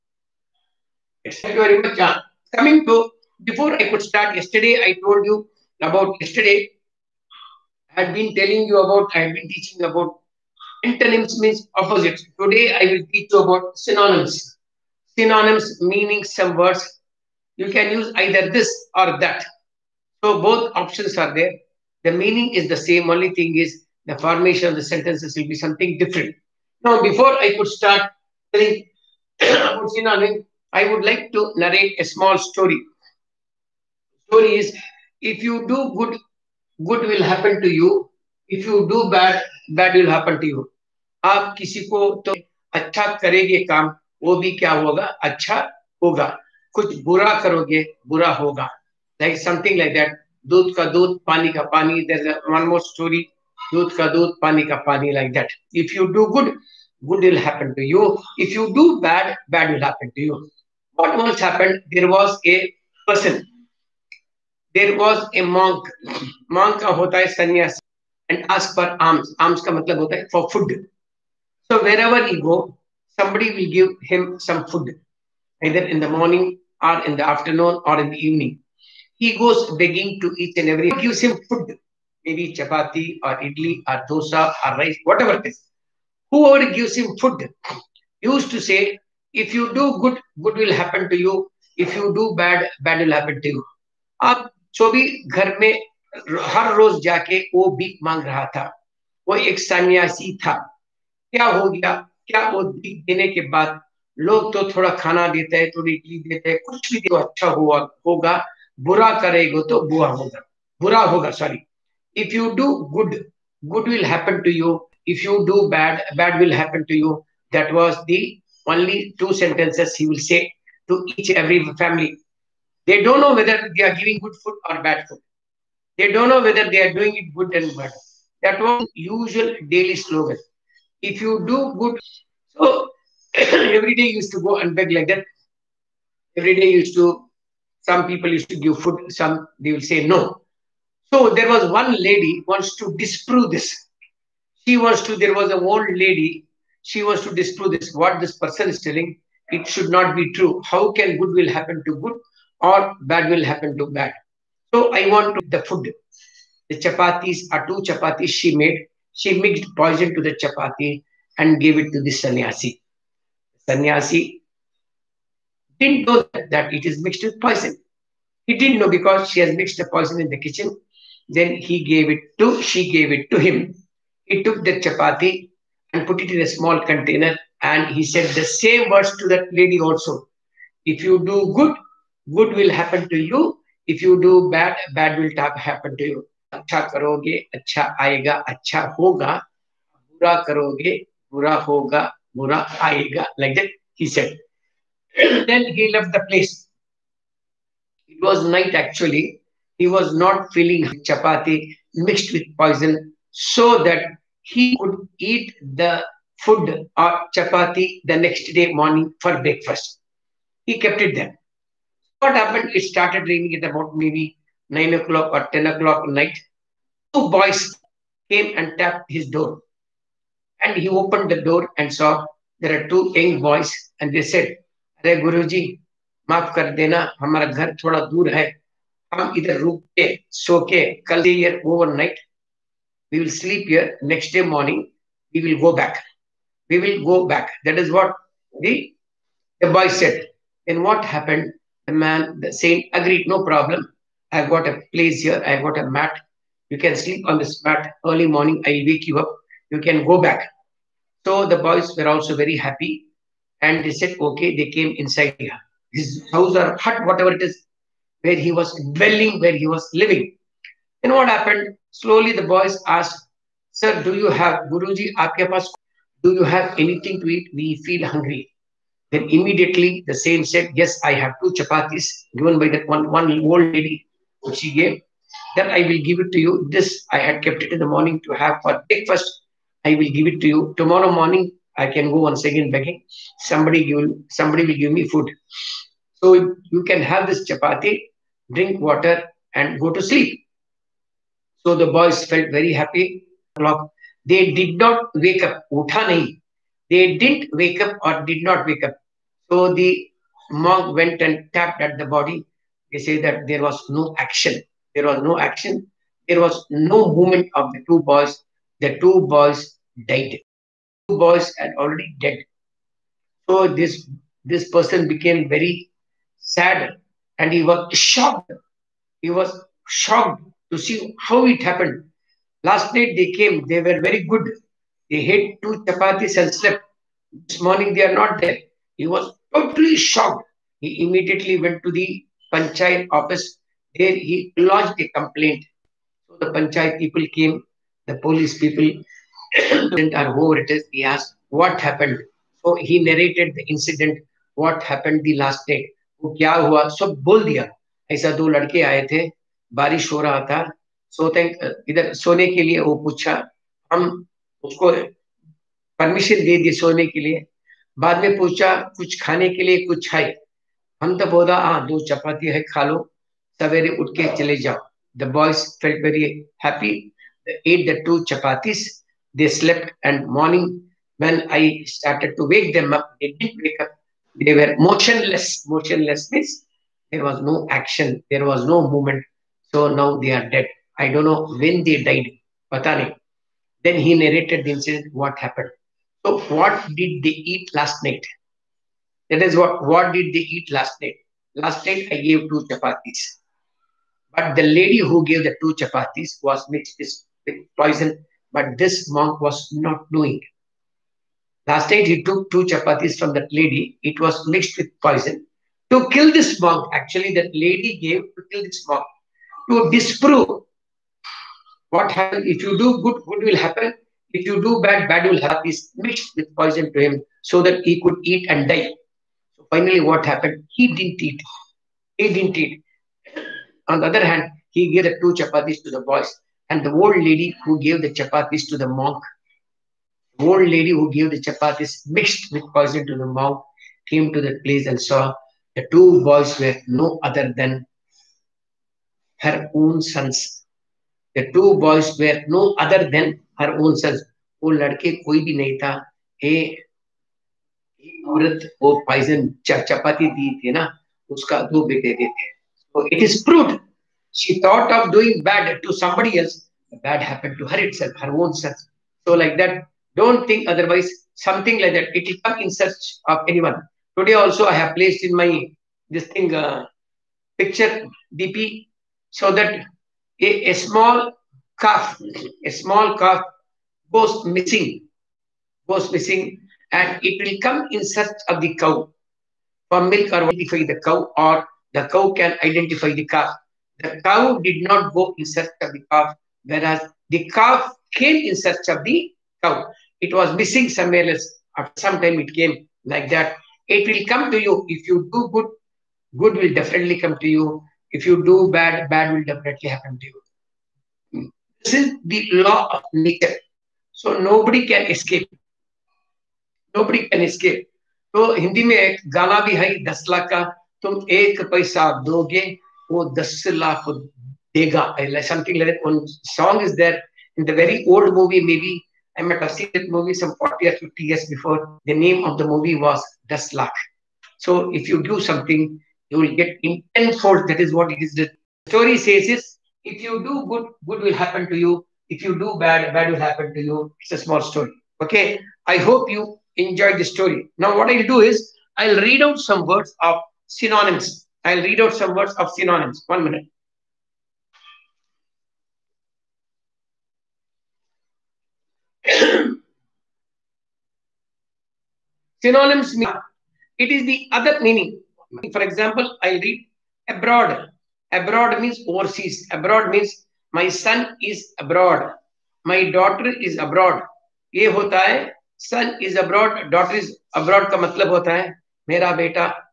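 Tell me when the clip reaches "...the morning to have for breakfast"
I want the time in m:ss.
4:37.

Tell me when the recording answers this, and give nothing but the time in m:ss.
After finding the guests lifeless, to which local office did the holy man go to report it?
5:32.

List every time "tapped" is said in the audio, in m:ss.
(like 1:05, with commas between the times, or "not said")
3:38, 5:01.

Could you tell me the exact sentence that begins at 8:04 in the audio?
The cow did not go in search of the calf, whereas the calf came in search of the cow.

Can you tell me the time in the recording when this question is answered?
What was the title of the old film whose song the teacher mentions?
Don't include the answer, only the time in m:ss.
8:43.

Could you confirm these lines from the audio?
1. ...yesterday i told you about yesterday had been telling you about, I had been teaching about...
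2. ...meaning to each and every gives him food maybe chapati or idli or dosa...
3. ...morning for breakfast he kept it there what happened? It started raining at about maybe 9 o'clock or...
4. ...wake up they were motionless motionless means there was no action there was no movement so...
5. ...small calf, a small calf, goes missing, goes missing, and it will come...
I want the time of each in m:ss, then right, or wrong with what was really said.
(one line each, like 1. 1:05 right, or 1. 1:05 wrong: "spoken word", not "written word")
1. 0:04 right
2. 1:19 wrong: "begging", not "meaning"
3. 3:28 right
4. 6:13 right
5. 7:50 right.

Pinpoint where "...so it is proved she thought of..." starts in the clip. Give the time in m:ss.
7:32.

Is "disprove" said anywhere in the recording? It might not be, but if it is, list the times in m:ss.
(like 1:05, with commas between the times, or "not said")
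2:22, 2:27, 6:49.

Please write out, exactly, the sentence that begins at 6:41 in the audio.
Last night he took two chapatis from that lady.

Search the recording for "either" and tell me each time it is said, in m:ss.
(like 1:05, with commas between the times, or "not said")
0:18, 1:15.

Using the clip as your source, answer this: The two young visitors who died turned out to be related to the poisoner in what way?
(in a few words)
her own sons.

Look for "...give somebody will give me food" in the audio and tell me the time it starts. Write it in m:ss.
4:43.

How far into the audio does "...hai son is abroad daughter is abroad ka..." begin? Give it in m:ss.
9:25.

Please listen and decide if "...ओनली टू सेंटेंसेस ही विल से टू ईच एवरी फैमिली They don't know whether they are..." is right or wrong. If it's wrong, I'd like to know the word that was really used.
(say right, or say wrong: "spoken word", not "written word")
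right.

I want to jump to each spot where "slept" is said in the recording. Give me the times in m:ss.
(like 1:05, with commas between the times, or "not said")
5:26, 6:09.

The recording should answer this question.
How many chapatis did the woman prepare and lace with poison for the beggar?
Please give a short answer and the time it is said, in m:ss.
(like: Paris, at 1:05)
2, at 2:37.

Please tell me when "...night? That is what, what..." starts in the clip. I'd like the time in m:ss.
6:28.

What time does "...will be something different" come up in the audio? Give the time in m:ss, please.
0:25.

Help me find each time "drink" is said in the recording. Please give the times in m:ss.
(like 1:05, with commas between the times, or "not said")
4:48.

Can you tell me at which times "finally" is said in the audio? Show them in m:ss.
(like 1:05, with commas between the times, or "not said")
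6:59.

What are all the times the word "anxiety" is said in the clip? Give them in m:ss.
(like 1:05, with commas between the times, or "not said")
not said.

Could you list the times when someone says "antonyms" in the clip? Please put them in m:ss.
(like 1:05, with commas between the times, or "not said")
0:10.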